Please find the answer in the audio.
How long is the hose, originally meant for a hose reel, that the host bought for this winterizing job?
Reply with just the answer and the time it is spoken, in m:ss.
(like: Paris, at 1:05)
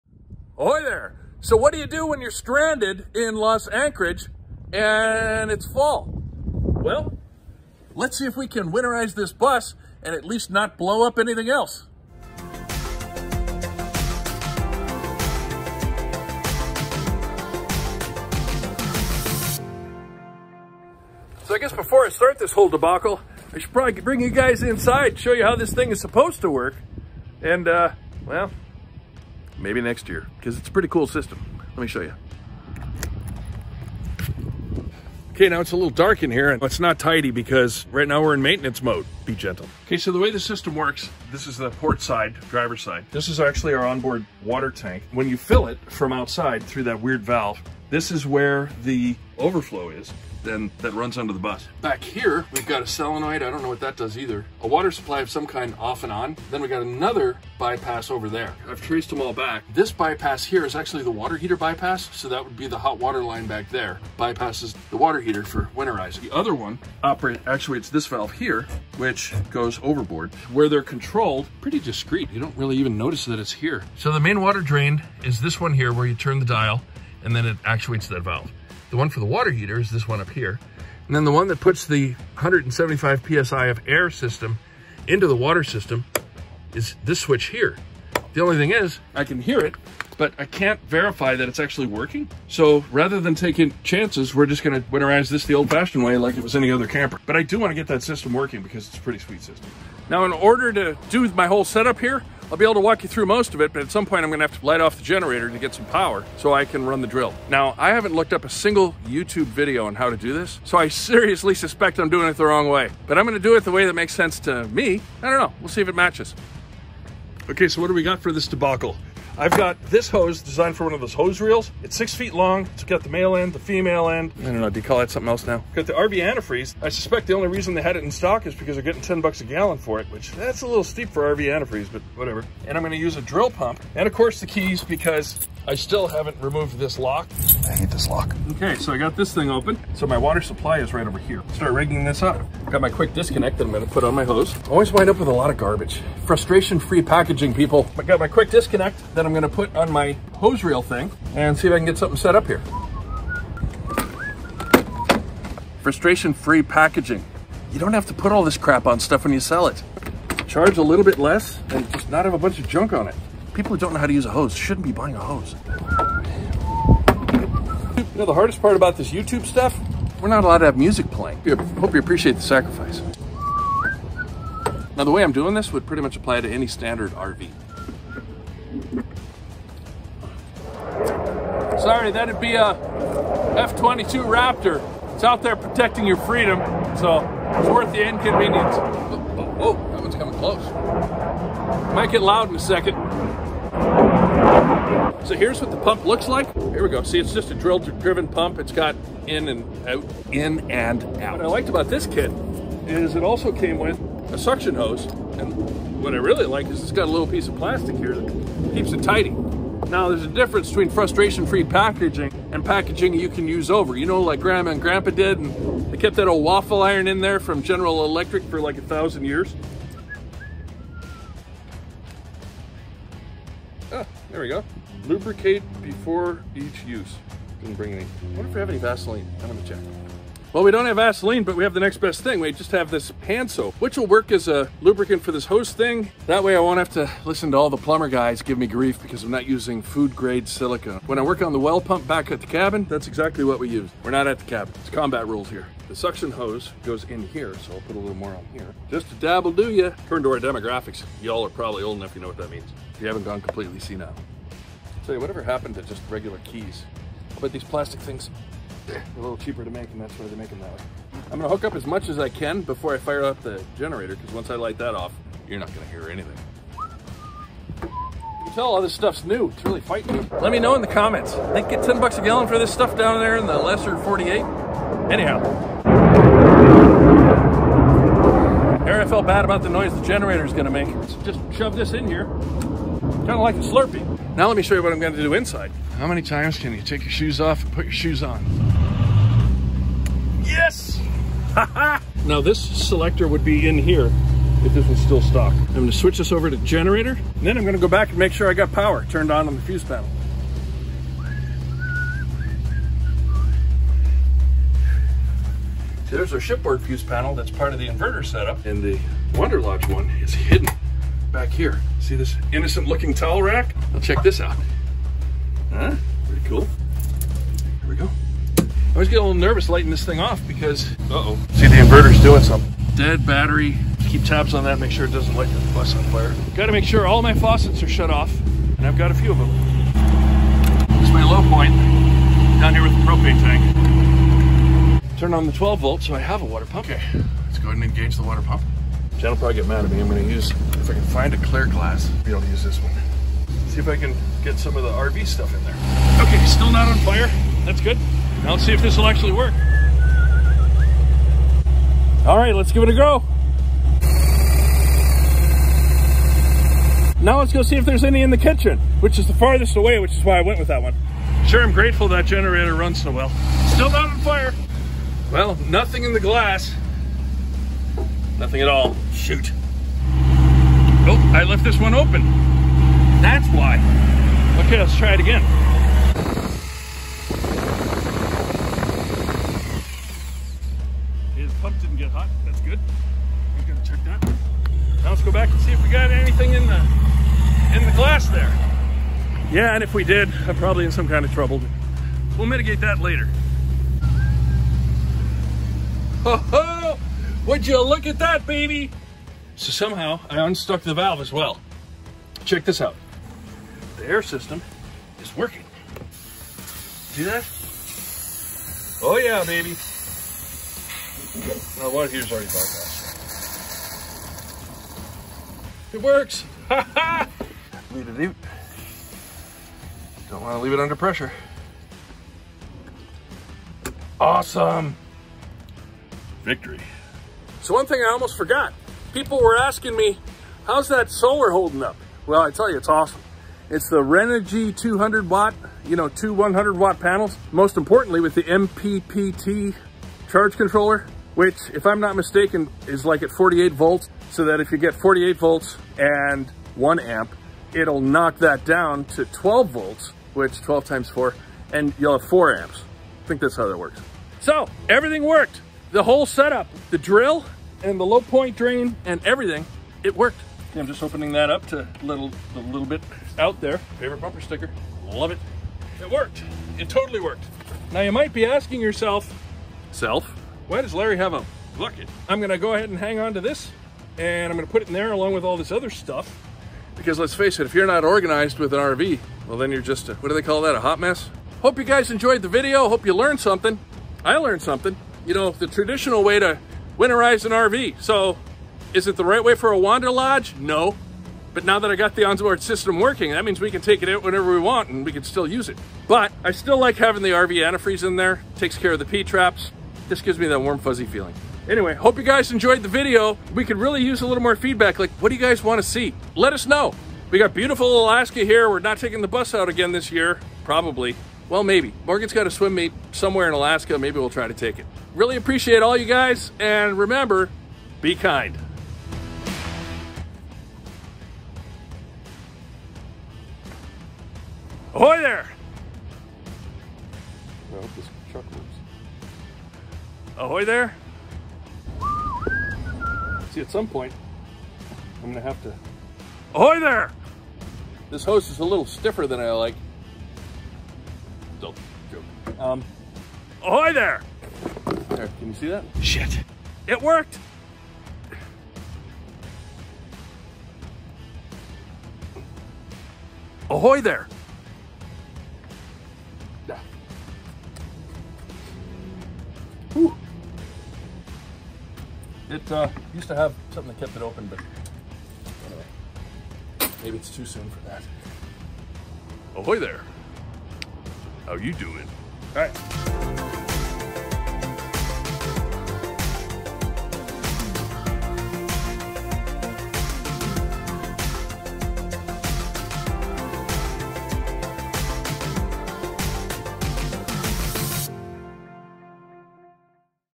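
6 feet, at 2:01.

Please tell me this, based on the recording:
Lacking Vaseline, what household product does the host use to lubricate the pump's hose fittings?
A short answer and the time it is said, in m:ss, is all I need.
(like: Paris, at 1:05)
Hand soap, at 3:53.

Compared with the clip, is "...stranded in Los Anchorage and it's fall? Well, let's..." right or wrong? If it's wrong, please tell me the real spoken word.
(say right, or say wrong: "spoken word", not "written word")
right.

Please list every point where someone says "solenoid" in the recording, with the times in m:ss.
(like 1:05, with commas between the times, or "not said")
0:52.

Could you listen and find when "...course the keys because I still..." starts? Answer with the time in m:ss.
2:14.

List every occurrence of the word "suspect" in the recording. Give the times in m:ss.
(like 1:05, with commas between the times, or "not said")
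1:51, 2:06.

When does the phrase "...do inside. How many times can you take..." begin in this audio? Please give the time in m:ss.
4:45.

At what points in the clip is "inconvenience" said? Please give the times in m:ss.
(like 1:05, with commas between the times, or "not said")
3:08.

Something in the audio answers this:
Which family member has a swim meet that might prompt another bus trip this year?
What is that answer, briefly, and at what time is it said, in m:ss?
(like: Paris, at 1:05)
Morgan, at 8:32.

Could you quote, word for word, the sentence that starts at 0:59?
This bypass here is actually the water heater bypass.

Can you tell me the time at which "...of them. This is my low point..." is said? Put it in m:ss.
5:29.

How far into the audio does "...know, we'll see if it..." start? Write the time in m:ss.
1:55.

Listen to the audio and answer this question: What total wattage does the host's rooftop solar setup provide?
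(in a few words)
200 watts.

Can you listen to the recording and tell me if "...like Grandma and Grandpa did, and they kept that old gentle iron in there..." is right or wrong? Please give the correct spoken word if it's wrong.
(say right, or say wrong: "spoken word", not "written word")
wrong: "waffle", not "gentle".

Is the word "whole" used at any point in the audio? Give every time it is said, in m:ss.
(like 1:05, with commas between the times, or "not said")
0:22, 1:41, 7:36.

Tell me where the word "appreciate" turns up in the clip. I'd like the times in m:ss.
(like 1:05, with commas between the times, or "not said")
2:51, 8:35.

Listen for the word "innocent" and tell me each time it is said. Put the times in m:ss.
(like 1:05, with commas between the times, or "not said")
5:12.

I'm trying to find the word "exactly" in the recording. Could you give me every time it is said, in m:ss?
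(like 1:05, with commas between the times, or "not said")
4:03.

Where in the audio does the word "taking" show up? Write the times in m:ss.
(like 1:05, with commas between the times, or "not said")
1:33, 8:28.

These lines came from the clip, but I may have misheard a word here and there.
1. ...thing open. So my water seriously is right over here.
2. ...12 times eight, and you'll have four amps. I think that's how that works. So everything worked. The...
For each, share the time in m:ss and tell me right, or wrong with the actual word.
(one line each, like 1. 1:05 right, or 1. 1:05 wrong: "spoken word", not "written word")
1. 2:19 wrong: "supply", not "seriously"
2. 7:30 wrong: "four", not "eight".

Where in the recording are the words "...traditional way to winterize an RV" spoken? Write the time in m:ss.
8:05.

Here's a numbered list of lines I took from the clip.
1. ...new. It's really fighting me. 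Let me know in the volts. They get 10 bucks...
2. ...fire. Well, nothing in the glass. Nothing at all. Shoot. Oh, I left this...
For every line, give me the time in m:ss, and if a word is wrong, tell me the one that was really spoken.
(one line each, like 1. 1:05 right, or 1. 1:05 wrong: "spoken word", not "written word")
1. 4:29 wrong: "comments", not "volts"
2. 6:04 right.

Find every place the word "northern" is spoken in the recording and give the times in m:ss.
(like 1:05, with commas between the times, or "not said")
not said.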